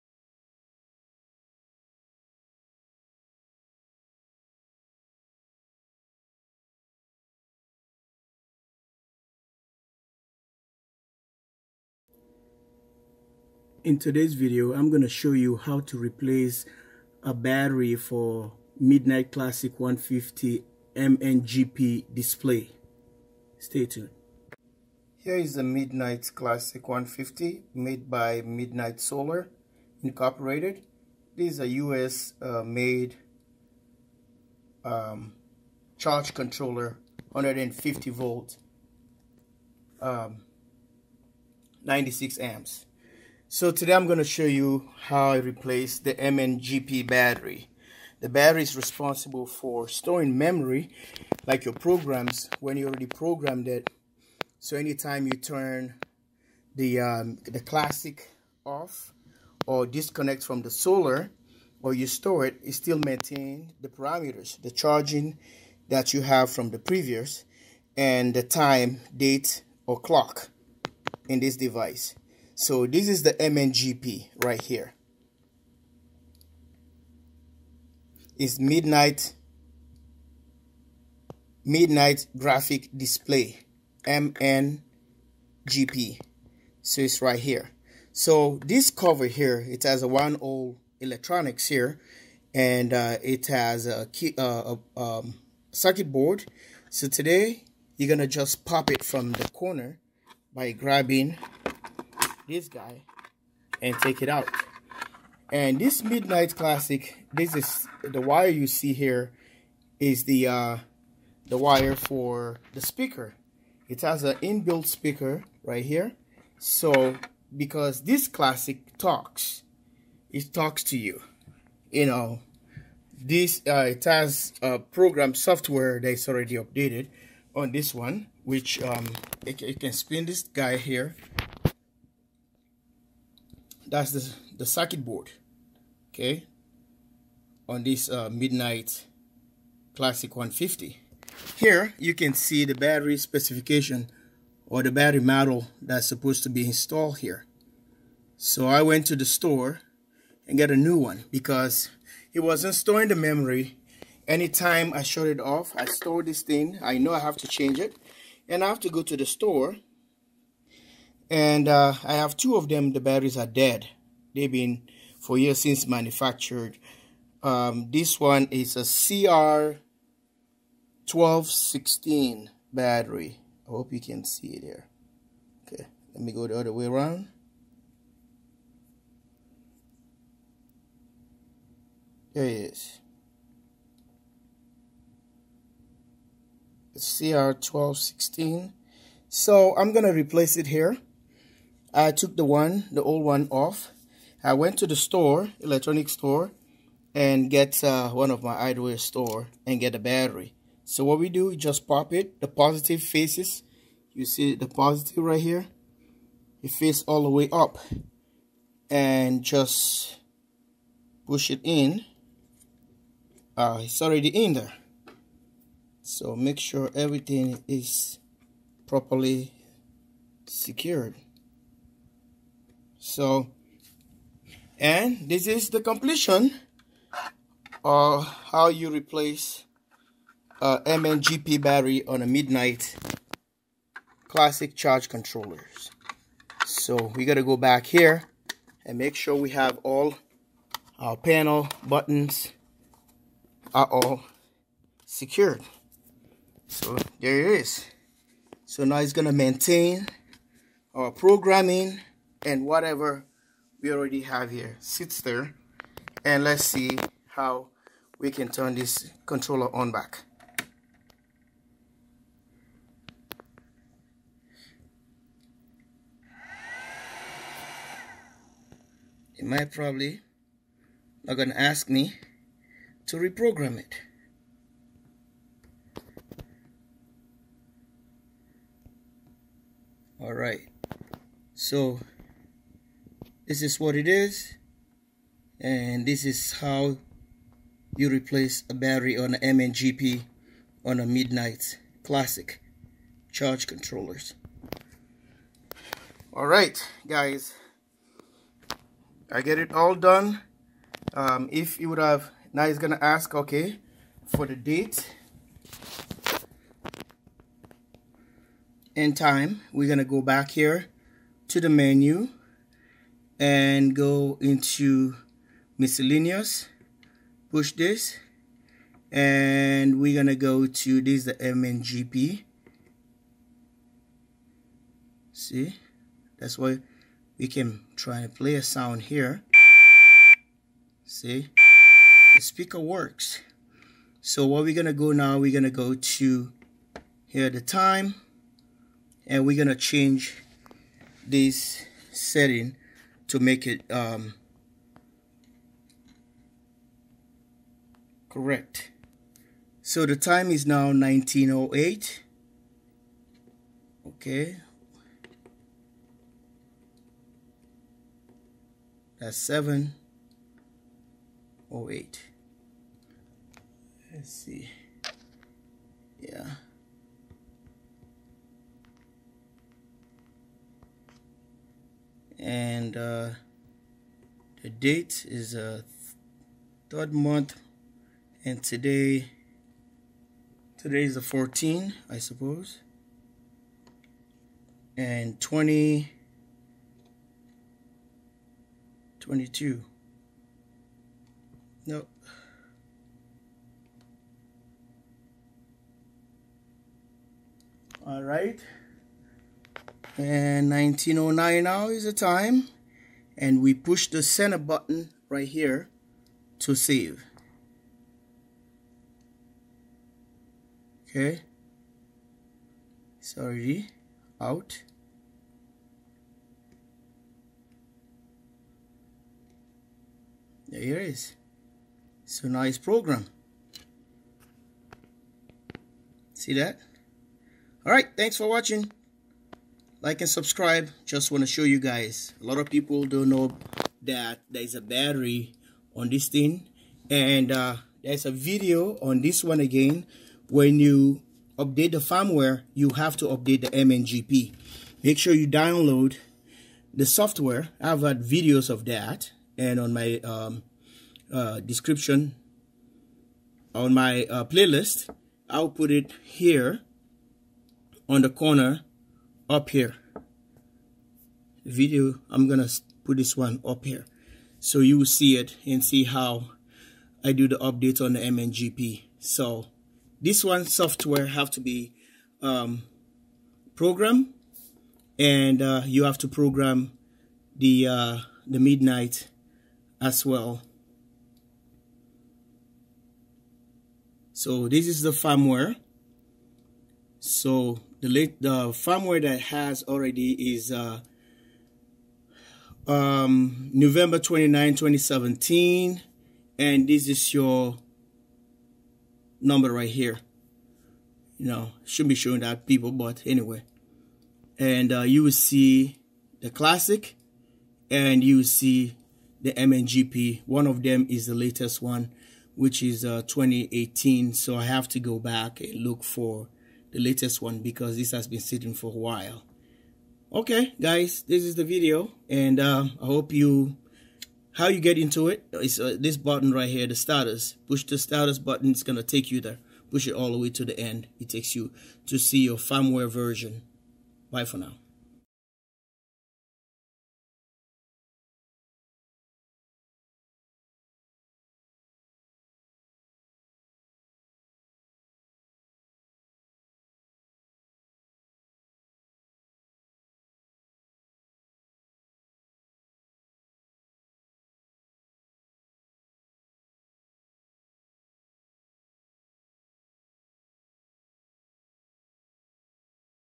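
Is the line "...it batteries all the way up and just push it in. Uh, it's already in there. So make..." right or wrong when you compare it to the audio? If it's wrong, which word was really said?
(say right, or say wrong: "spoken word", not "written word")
wrong: "faces", not "batteries".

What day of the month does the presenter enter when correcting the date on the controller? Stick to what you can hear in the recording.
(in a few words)
14.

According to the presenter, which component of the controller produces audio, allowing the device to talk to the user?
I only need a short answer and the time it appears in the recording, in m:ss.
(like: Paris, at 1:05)
inbuilt speaker, at 1:54.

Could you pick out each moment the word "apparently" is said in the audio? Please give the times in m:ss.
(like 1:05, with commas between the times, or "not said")
not said.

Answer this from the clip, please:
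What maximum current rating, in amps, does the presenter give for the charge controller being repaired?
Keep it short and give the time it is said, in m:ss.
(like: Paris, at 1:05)
96 amps, at 0:41.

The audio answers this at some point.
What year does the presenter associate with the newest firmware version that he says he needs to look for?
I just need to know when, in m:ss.
8:33.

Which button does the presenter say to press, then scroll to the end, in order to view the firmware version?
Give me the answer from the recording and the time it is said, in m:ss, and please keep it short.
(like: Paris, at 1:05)
status button, at 8:47.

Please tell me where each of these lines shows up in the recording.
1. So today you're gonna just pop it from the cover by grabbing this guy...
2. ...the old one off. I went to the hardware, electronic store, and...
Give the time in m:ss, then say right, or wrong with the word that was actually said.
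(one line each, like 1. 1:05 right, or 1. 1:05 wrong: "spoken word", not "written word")
1. 1:36 wrong: "corner", not "cover"
2. 3:12 wrong: "store", not "hardware".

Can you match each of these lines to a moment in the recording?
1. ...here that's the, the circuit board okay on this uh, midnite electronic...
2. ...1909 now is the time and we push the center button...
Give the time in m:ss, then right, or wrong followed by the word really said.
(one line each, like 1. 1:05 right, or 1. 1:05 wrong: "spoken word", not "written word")
1. 2:10 wrong: "classic", not "electronic"
2. 6:40 right.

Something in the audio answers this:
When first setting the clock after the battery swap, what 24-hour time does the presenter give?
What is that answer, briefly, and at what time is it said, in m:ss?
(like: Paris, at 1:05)
1908, at 5:50.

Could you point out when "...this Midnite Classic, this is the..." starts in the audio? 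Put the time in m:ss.
1:45.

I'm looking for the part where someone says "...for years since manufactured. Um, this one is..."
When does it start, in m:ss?
2:45.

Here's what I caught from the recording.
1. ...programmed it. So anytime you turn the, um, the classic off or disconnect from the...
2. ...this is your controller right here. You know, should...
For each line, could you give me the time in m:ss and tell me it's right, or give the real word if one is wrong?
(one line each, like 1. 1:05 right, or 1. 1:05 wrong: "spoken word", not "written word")
1. 0:53 right
2. 8:16 wrong: "number", not "controller".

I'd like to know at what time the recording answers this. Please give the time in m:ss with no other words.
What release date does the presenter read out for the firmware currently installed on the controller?
8:13.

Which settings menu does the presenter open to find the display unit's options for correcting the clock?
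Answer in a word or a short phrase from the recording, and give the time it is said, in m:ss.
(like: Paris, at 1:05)
miscellaneous, at 5:15.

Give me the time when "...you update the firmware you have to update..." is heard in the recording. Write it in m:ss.
7:20.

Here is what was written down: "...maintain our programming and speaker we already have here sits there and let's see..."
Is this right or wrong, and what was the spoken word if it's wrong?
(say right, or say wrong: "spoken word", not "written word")
wrong: "whatever", not "speaker".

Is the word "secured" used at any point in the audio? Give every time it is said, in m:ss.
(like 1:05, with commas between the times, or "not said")
3:40, 4:05.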